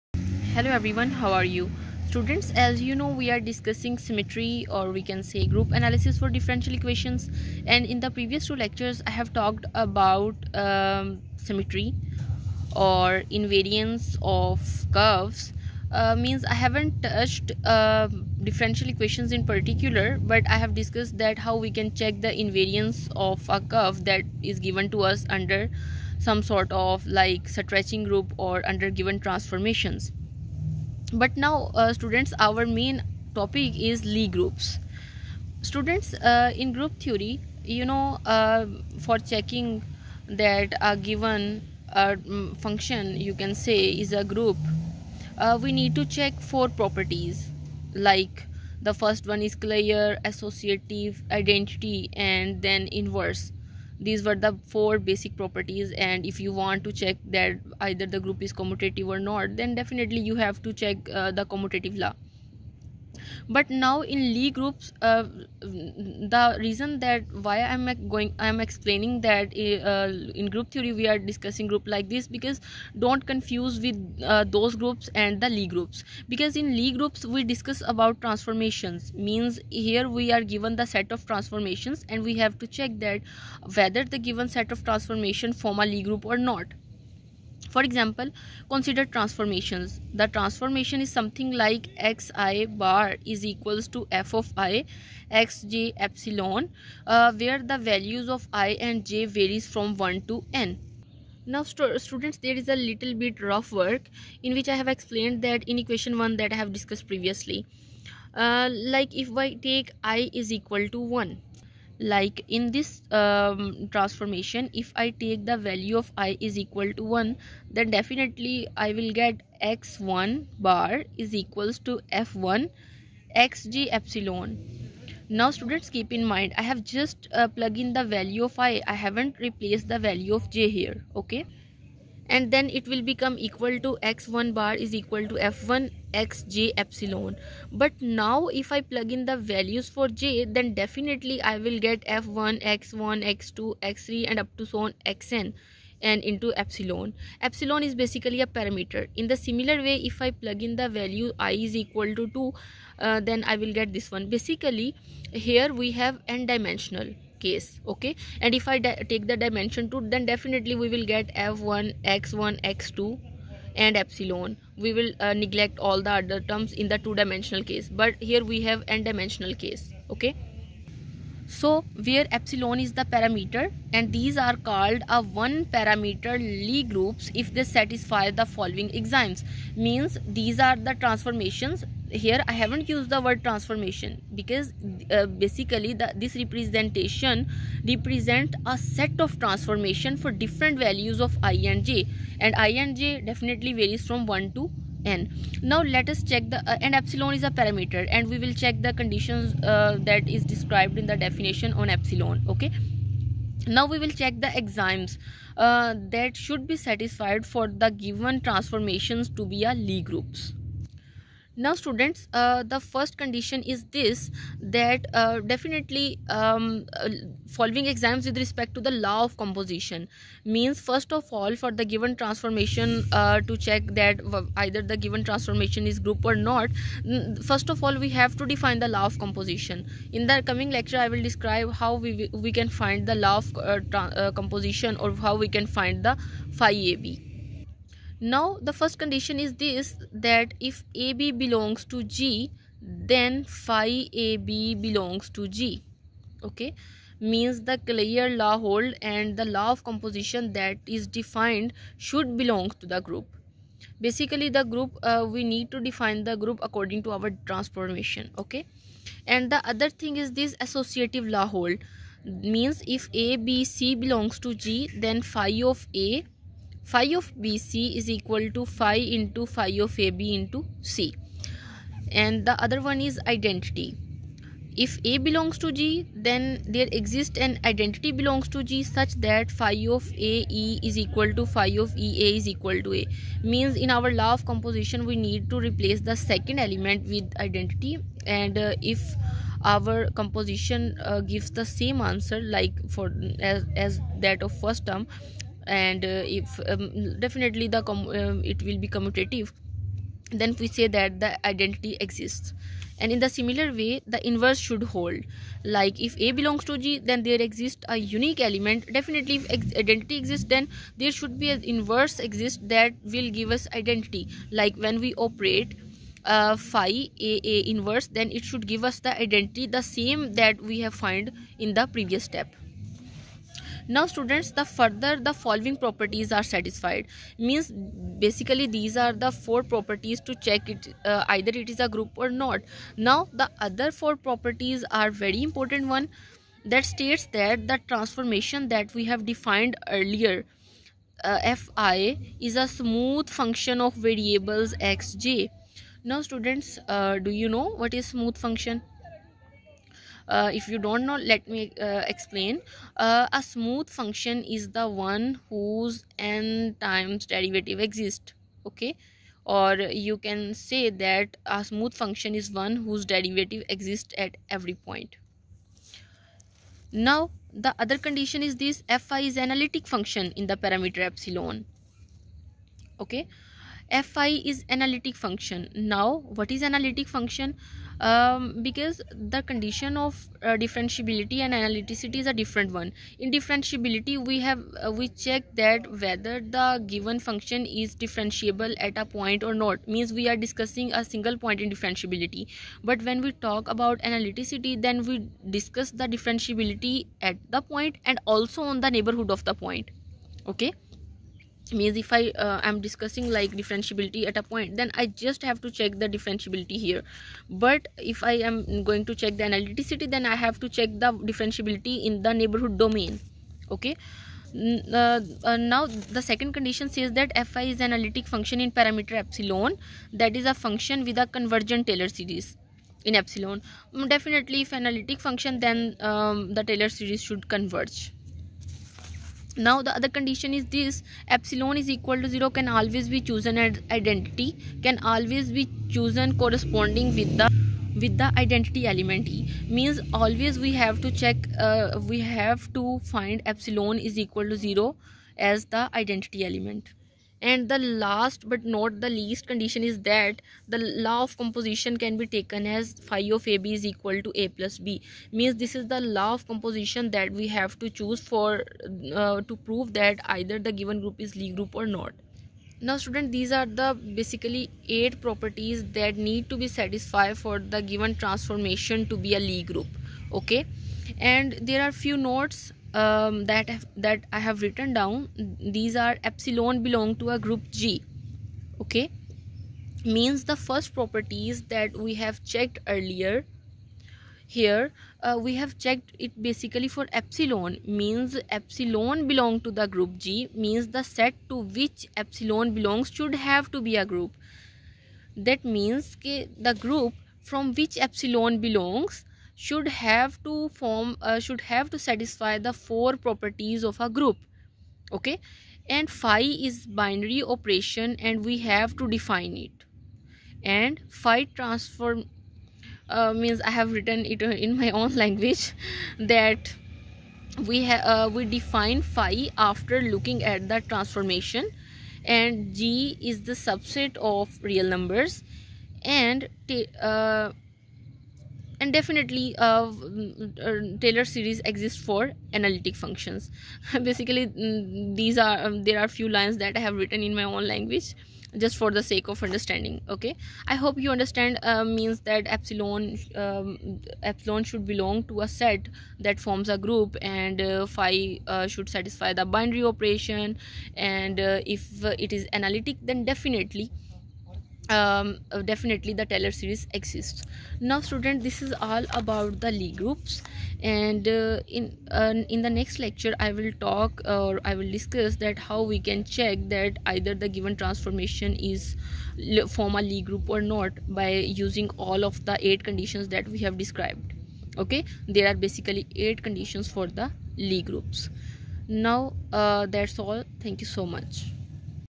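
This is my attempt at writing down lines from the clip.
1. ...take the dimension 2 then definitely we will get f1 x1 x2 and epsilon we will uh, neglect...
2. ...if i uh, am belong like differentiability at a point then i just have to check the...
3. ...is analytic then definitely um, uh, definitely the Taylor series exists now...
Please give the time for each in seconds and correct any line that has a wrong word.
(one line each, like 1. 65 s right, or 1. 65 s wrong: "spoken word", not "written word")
1. 158 s right
2. 401 s wrong: "discussing", not "belong"
3. 552 s right.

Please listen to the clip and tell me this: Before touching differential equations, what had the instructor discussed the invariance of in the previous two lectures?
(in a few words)
Curves.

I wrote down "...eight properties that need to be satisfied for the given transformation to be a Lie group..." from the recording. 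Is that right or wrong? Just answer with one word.
right.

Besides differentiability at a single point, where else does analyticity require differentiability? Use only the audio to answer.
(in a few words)
In the neighborhood.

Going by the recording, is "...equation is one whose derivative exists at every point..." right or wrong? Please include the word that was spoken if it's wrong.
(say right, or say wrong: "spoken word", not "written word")
wrong: "function", not "equation".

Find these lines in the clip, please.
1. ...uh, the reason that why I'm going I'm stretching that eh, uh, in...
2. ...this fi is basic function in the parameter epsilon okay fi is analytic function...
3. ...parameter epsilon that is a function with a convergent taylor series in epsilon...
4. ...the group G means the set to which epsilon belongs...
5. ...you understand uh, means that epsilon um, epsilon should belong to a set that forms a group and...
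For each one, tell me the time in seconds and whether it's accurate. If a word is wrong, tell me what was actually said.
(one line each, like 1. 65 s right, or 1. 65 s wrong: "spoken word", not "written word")
1. 65 s wrong: "explaining", not "stretching"
2. 368 s wrong: "analytic", not "basic"
3. 418 s right
4. 489 s right
5. 540 s right.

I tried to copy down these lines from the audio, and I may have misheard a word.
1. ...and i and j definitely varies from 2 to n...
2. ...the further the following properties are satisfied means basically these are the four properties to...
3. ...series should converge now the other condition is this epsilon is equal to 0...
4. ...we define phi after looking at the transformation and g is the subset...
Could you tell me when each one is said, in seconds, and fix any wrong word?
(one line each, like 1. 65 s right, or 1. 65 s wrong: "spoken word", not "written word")
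1. 192 s wrong: "1", not "2"
2. 324 s right
3. 426 s right
4. 518 s right.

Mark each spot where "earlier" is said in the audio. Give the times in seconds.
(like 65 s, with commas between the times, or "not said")
339 s, 482 s.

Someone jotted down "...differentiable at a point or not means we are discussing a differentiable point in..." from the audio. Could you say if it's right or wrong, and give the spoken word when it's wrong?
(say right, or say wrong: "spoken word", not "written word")
wrong: "single", not "differentiable".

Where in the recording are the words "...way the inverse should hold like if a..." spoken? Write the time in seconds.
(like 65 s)
303 s.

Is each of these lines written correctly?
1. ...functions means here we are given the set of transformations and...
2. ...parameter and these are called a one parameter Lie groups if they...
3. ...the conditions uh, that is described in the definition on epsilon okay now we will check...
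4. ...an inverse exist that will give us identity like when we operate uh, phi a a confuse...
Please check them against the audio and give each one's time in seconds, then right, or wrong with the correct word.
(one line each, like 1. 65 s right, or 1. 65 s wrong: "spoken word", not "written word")
1. 78 s wrong: "transformations", not "functions"
2. 173 s right
3. 198 s right
4. 311 s wrong: "inverse", not "confuse".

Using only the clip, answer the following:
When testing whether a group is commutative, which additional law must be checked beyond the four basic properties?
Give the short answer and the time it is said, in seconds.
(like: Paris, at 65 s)
Commutative law, at 61 s.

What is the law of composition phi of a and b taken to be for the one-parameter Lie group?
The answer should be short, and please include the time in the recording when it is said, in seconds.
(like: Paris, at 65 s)
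a plus b, at 454 s.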